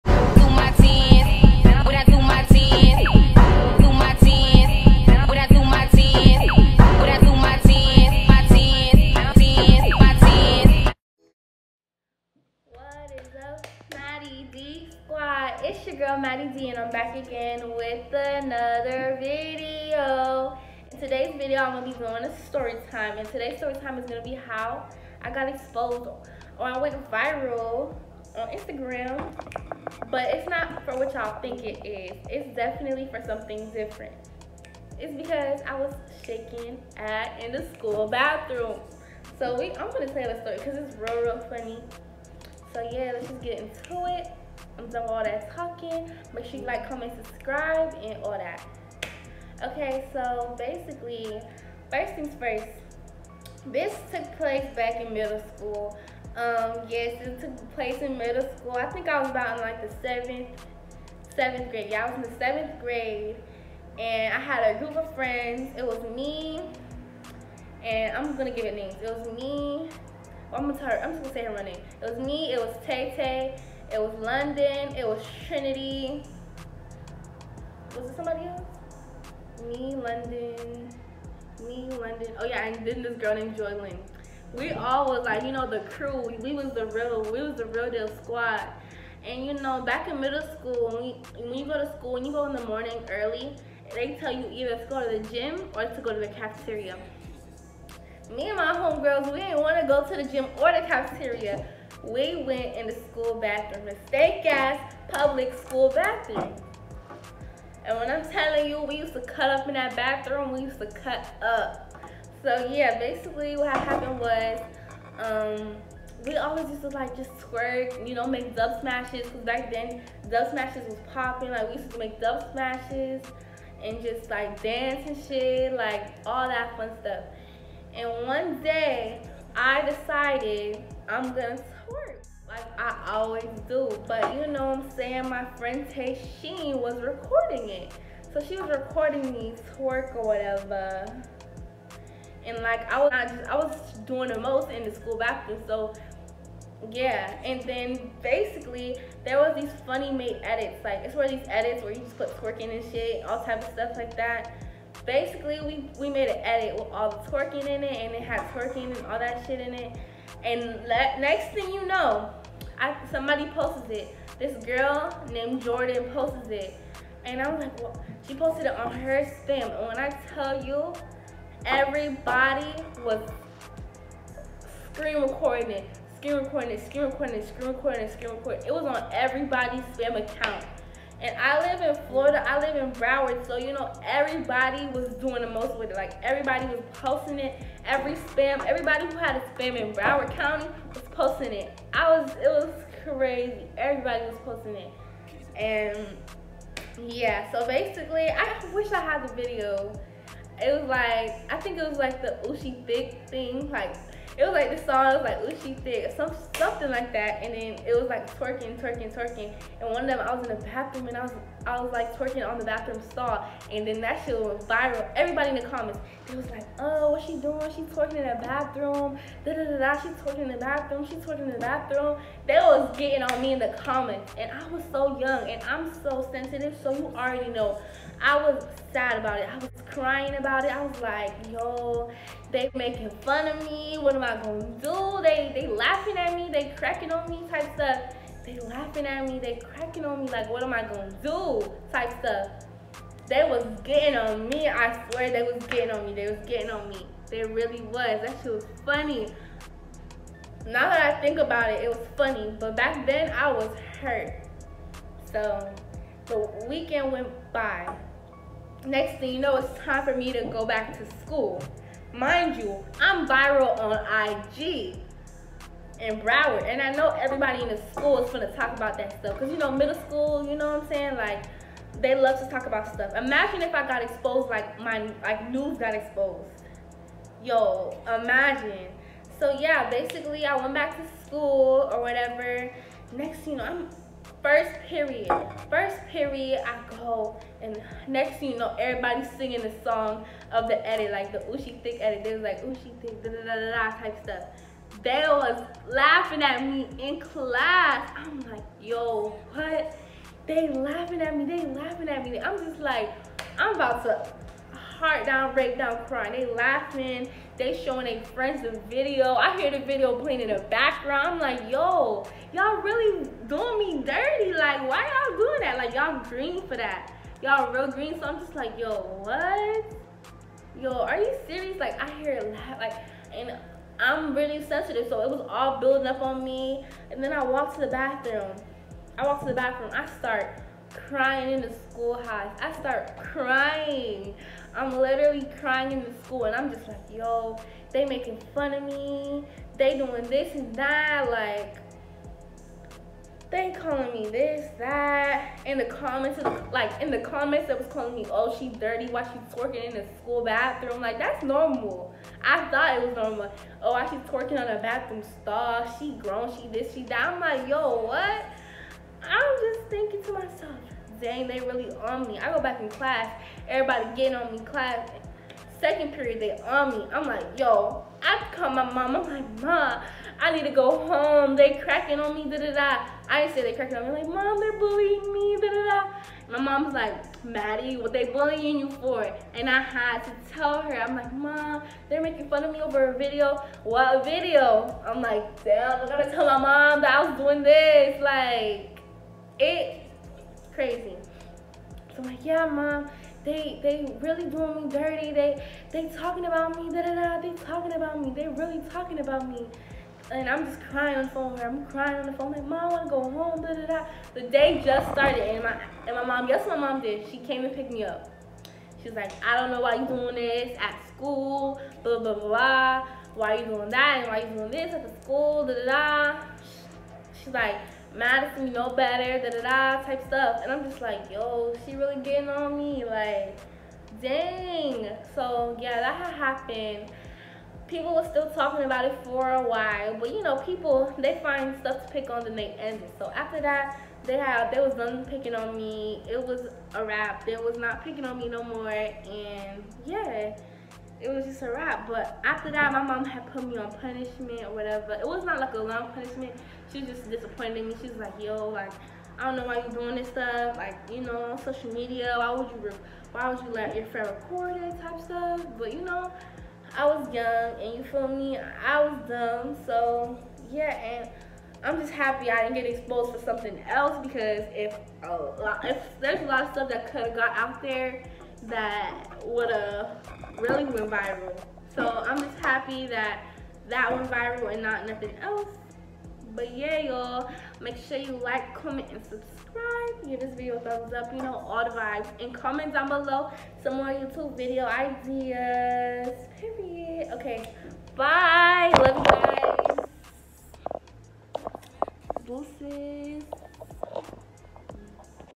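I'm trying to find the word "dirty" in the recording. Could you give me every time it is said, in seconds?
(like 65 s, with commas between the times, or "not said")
314 s, 348 s, 394 s.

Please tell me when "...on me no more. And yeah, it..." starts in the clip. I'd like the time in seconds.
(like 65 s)
438 s.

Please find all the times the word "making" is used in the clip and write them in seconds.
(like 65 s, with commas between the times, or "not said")
232 s, 338 s, 382 s.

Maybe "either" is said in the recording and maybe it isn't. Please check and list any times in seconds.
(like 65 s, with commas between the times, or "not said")
94 s.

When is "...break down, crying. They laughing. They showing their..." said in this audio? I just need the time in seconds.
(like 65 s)
305 s.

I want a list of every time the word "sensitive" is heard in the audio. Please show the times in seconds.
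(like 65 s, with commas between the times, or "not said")
226 s, 324 s.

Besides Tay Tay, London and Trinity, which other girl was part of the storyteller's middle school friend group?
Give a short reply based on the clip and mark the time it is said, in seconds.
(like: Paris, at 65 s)
Joylyn, at 83 s.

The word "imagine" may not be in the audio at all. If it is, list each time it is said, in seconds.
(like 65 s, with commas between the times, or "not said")
273 s, 278 s.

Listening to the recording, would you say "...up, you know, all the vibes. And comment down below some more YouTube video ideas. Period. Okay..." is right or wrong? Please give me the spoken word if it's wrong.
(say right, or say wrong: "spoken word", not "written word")
right.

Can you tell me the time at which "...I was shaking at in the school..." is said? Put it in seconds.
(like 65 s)
35 s.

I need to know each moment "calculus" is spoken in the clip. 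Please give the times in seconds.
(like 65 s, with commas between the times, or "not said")
not said.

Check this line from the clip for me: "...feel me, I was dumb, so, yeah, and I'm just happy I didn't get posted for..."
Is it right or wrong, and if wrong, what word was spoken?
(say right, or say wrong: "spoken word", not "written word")
wrong: "exposed", not "posted".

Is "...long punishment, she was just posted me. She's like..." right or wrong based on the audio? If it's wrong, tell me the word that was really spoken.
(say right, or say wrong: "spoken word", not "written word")
wrong: "disappointed", not "posted".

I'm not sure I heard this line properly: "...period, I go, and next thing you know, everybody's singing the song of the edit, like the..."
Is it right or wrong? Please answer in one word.
right.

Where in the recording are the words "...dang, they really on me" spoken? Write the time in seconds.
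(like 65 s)
361 s.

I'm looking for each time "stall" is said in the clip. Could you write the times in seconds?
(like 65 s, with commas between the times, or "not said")
213 s, 355 s.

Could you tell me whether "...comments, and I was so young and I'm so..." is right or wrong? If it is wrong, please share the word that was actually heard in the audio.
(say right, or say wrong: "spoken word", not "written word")
right.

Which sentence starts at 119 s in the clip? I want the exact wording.
Cause back then dub smashes was popping.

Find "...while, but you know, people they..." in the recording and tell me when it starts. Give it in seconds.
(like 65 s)
429 s.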